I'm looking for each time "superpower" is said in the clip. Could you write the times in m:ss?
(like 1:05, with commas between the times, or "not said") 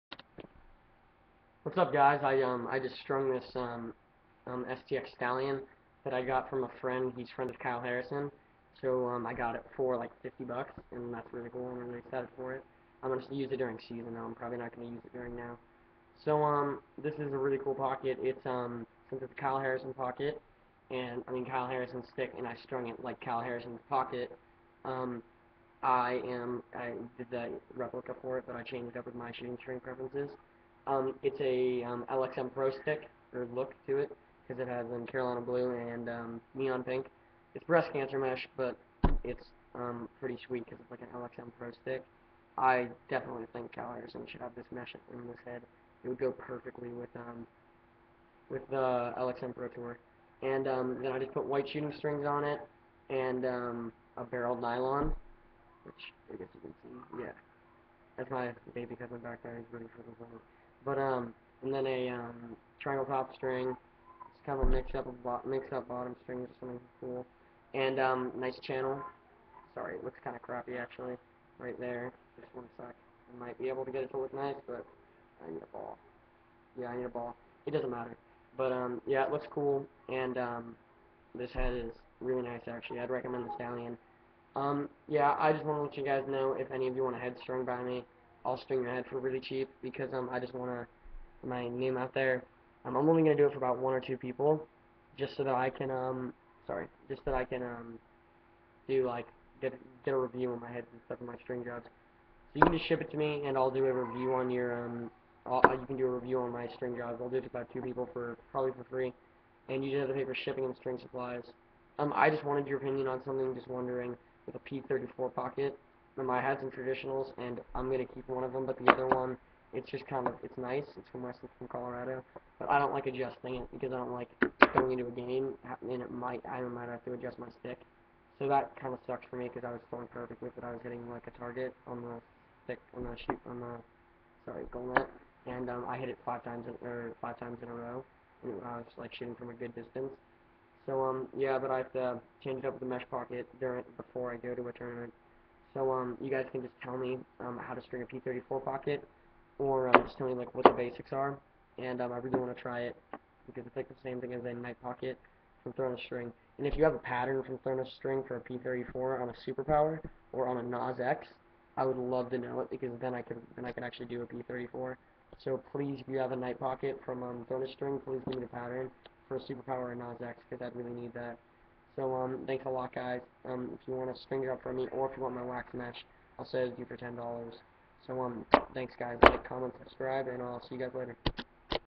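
2:39, 2:49.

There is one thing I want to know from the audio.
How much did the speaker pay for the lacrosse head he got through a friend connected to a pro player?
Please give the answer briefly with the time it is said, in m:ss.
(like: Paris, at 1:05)
$50, at 0:10.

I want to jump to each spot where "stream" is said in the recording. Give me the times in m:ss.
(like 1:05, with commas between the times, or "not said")
1:28.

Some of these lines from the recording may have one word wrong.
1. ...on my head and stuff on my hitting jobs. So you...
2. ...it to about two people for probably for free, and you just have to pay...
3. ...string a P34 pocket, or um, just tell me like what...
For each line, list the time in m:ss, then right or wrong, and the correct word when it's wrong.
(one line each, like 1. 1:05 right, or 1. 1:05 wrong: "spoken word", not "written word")
1. 1:40 wrong: "string", not "hitting"
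2. 1:47 right
3. 2:27 right.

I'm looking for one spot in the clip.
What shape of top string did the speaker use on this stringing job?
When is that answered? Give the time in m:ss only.
1:02.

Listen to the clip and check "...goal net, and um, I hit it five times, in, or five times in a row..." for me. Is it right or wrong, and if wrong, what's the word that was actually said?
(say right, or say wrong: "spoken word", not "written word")
right.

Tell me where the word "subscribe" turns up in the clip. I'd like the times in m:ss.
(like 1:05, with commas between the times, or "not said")
2:59.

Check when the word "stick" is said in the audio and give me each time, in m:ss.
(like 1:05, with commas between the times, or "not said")
0:22, 0:32, 0:41, 2:07, 2:12.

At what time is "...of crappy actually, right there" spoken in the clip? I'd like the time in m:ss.
1:10.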